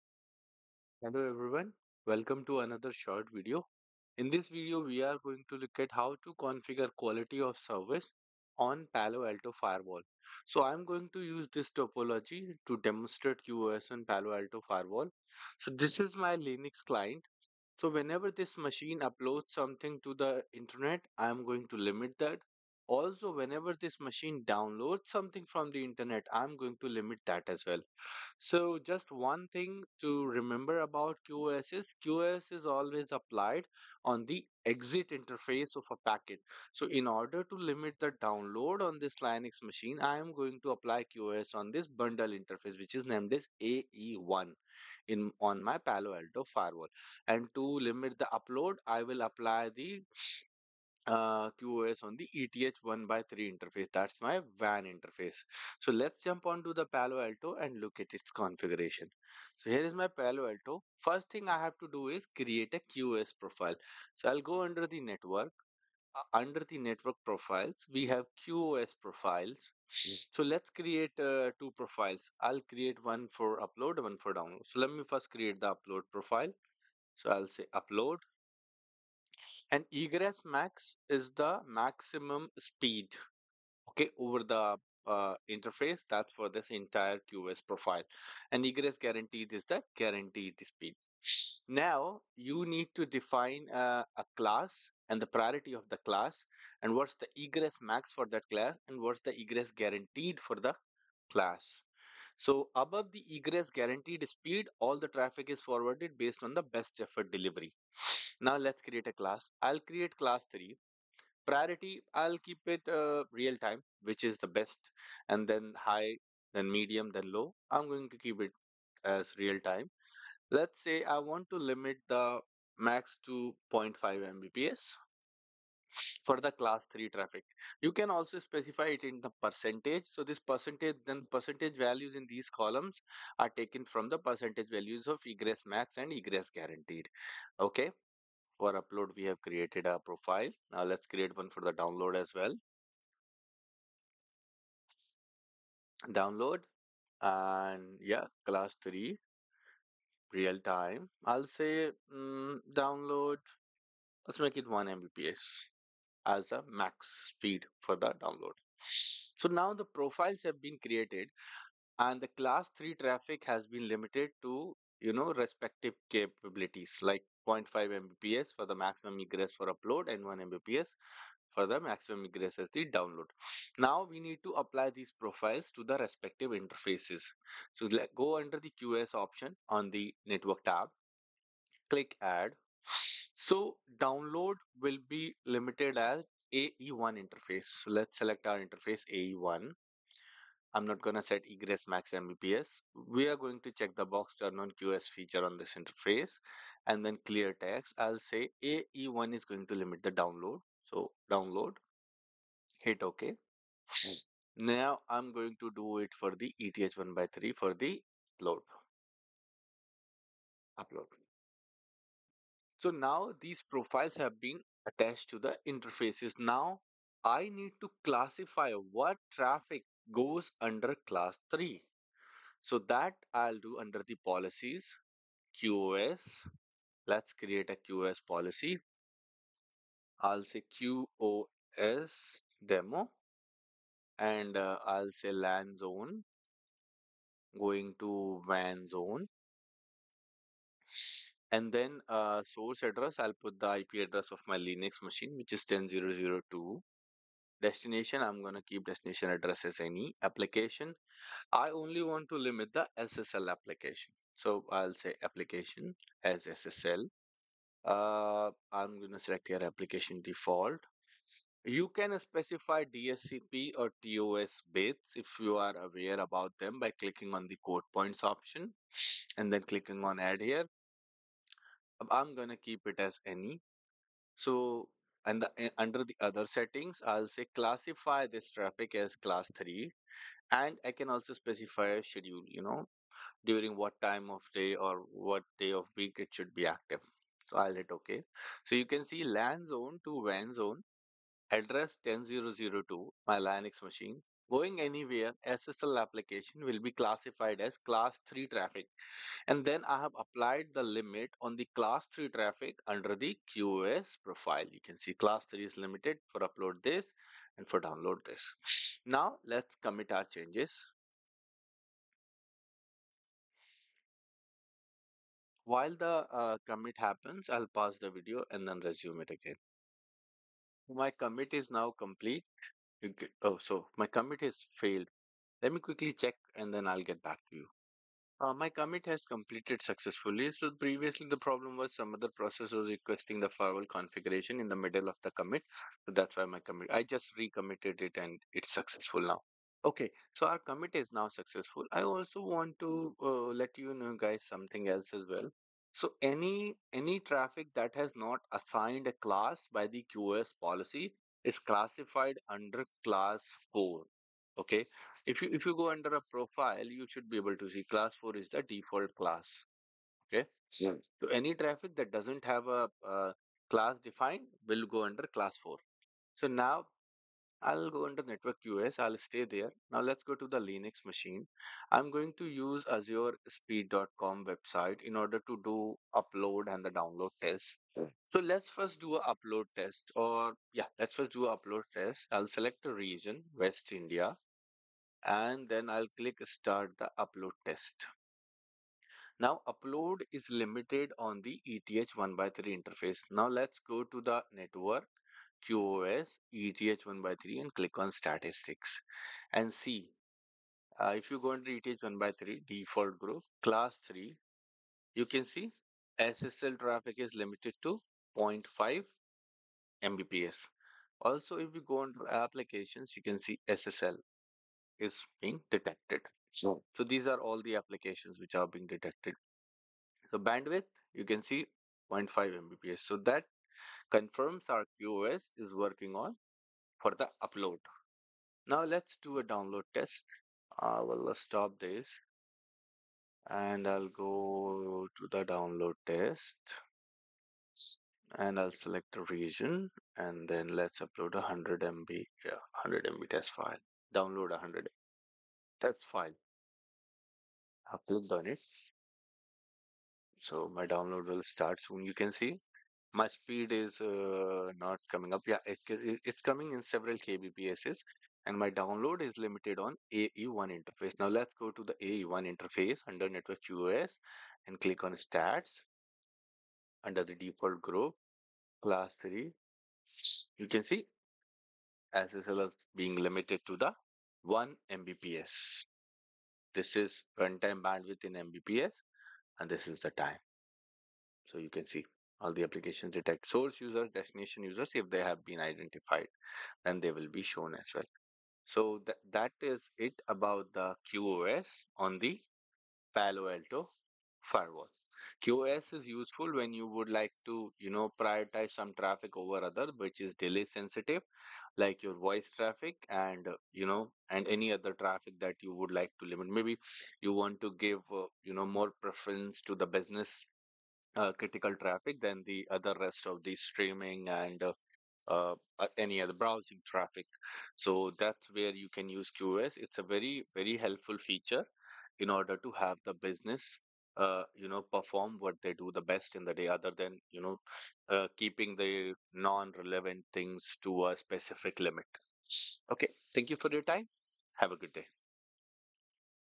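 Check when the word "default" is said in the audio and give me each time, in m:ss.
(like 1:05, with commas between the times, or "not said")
4:20, 5:58, 6:42, 7:47.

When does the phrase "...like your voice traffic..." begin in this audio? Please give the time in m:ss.
8:21.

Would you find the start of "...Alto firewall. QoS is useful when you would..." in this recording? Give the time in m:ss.
8:13.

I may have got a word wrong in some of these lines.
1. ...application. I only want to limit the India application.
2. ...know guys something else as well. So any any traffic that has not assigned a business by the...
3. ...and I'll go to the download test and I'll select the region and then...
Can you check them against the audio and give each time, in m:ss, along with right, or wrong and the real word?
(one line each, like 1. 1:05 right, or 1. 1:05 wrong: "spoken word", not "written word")
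1. 4:10 wrong: "SSL", not "India"
2. 5:43 wrong: "class", not "business"
3. 7:13 right.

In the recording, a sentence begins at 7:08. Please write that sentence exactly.
Now let's do a download test.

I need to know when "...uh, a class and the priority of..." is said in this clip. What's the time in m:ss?
1:33.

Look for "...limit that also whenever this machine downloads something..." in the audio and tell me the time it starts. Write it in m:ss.
0:21.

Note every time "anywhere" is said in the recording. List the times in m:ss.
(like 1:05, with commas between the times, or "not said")
4:54.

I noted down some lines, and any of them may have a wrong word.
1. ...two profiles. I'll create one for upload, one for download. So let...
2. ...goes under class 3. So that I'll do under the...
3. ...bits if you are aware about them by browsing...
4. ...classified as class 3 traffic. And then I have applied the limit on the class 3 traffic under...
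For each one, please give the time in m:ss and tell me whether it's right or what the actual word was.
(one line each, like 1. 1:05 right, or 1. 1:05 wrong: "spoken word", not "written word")
1. 1:11 right
2. 3:40 right
3. 4:24 wrong: "clicking", not "browsing"
4. 4:56 right.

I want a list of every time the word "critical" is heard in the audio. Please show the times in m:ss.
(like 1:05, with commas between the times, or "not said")
8:31.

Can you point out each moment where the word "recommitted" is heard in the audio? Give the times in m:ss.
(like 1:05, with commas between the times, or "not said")
5:37.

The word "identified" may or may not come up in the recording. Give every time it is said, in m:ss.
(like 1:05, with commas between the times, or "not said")
8:05.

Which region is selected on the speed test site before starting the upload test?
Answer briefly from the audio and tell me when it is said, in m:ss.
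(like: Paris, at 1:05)
West India, at 6:23.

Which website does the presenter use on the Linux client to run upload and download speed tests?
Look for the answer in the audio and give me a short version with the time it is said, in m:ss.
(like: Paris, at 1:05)
Azure Speed.com, at 6:12.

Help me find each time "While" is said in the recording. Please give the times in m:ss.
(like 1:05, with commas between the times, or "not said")
5:15.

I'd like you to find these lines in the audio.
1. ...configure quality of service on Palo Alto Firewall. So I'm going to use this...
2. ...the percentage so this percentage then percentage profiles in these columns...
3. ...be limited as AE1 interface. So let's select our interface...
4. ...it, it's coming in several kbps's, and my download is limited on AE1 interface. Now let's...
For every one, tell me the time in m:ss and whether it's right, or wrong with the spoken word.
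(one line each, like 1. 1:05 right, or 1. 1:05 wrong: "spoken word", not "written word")
1. 0:06 right
2. 2:09 wrong: "values", not "profiles"
3. 3:05 right
4. 7:35 right.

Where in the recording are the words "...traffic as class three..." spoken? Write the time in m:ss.
4:38.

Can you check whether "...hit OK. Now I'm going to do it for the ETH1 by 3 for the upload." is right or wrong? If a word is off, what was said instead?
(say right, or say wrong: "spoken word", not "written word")
right.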